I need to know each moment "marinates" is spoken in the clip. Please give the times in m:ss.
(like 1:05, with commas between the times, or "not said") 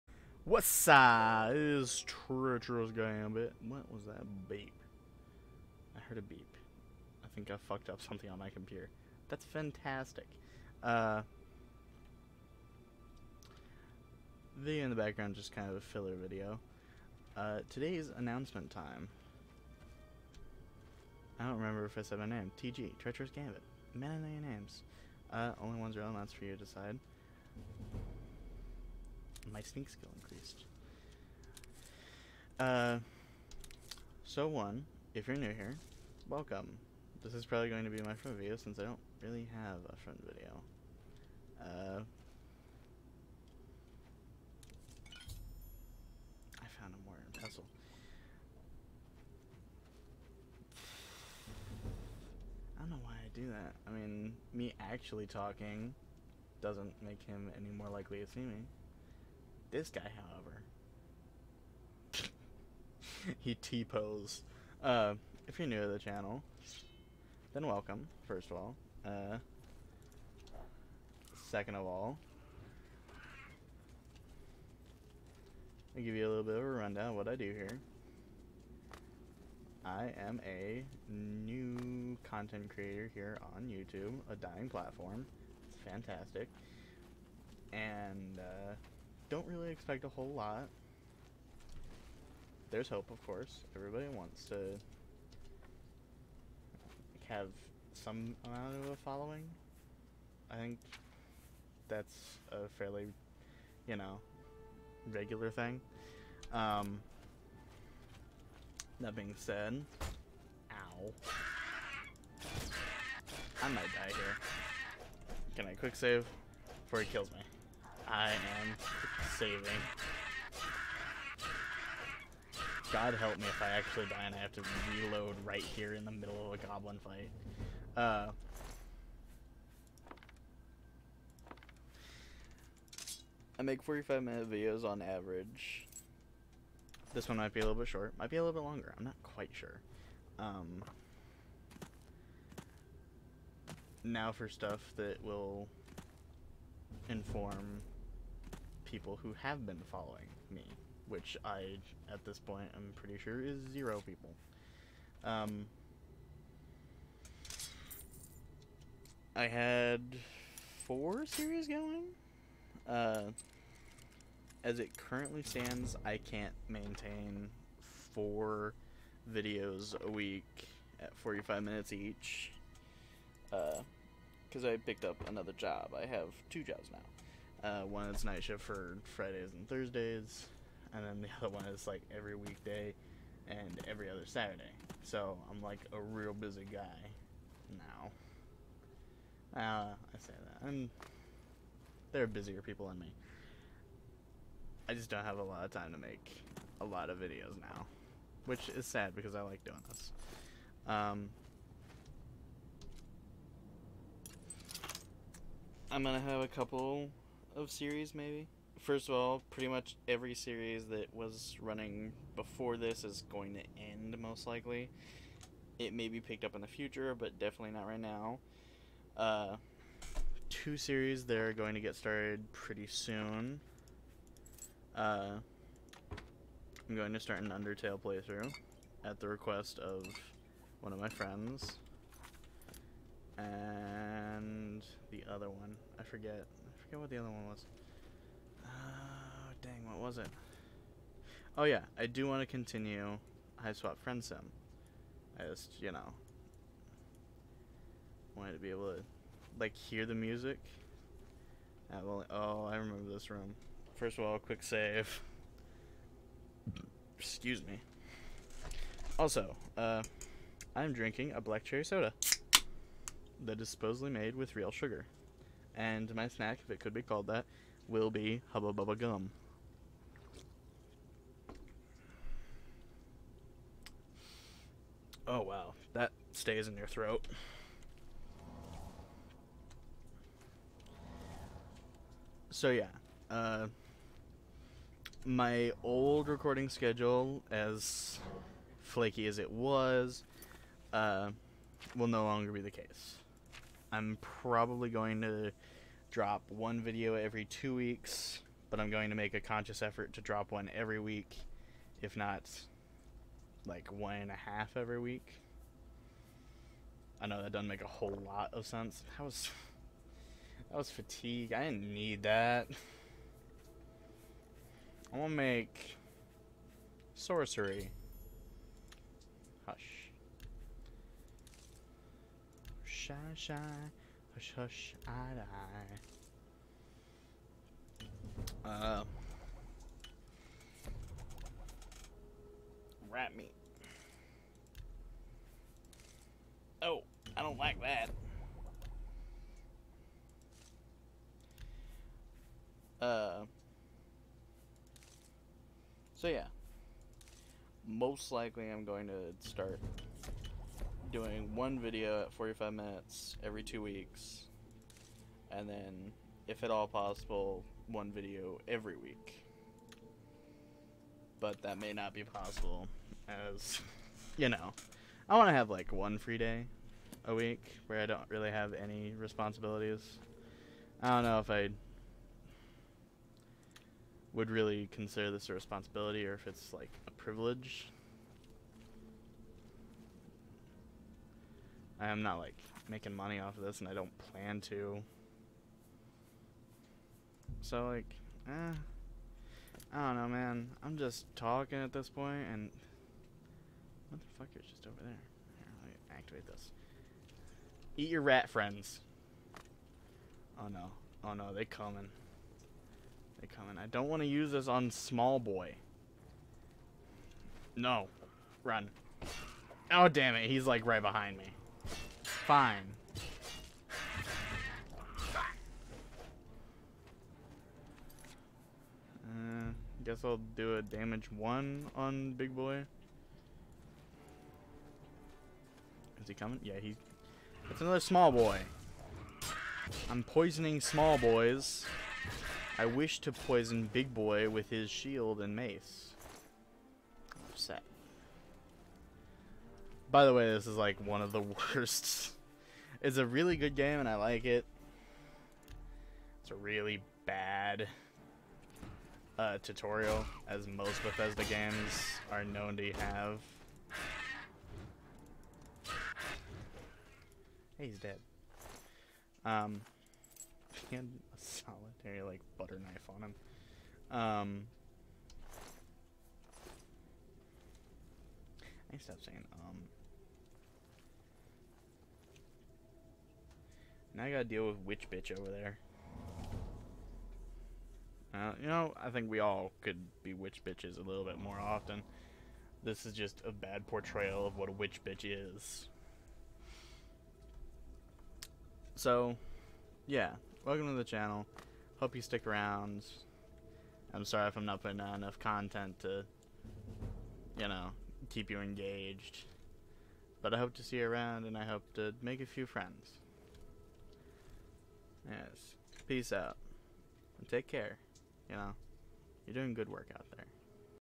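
not said.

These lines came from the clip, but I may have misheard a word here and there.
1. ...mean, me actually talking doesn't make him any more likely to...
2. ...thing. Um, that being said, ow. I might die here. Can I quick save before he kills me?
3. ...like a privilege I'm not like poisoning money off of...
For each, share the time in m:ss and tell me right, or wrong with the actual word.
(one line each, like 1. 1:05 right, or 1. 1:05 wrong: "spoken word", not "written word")
1. 0:53 right
2. 1:45 right
3. 6:16 wrong: "making", not "poisoning".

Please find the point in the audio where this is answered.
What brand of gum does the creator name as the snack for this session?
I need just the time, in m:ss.
4:28.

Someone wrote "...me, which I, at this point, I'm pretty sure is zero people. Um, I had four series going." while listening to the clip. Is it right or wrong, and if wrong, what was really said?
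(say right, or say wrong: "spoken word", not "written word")
right.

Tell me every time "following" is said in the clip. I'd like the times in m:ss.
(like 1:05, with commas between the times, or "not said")
1:38, 2:29.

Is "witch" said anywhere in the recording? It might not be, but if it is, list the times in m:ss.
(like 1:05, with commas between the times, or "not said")
7:54, 8:00, 8:04.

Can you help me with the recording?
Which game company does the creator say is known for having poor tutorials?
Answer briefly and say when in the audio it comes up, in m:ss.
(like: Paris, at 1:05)
Bethesda, at 7:31.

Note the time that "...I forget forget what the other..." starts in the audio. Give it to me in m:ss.
3:55.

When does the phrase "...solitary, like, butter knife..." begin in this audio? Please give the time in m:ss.
7:41.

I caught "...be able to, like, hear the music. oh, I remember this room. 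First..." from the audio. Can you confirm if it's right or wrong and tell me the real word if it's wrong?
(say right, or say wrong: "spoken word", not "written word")
right.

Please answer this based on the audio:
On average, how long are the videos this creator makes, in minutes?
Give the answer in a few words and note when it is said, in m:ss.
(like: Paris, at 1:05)
45 minutes, at 2:13.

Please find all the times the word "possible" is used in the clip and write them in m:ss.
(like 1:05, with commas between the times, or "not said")
5:56, 6:02.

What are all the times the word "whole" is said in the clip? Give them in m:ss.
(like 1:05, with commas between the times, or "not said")
1:30, 5:07.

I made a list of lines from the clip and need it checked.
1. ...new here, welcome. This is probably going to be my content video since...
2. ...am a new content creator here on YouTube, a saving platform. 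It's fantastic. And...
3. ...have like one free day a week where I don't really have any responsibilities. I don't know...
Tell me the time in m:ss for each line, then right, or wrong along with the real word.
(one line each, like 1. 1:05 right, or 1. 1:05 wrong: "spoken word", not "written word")
1. 0:35 wrong: "front", not "content"
2. 1:20 wrong: "dying", not "saving"
3. 6:05 right.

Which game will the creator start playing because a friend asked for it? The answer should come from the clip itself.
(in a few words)
Undertale.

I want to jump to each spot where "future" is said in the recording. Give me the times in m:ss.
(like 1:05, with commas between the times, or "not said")
3:36.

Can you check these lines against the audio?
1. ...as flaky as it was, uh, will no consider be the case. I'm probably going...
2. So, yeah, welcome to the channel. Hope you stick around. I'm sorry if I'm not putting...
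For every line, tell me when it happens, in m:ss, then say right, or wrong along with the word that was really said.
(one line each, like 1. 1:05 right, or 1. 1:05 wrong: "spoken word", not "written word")
1. 4:47 wrong: "longer", not "consider"
2. 8:08 right.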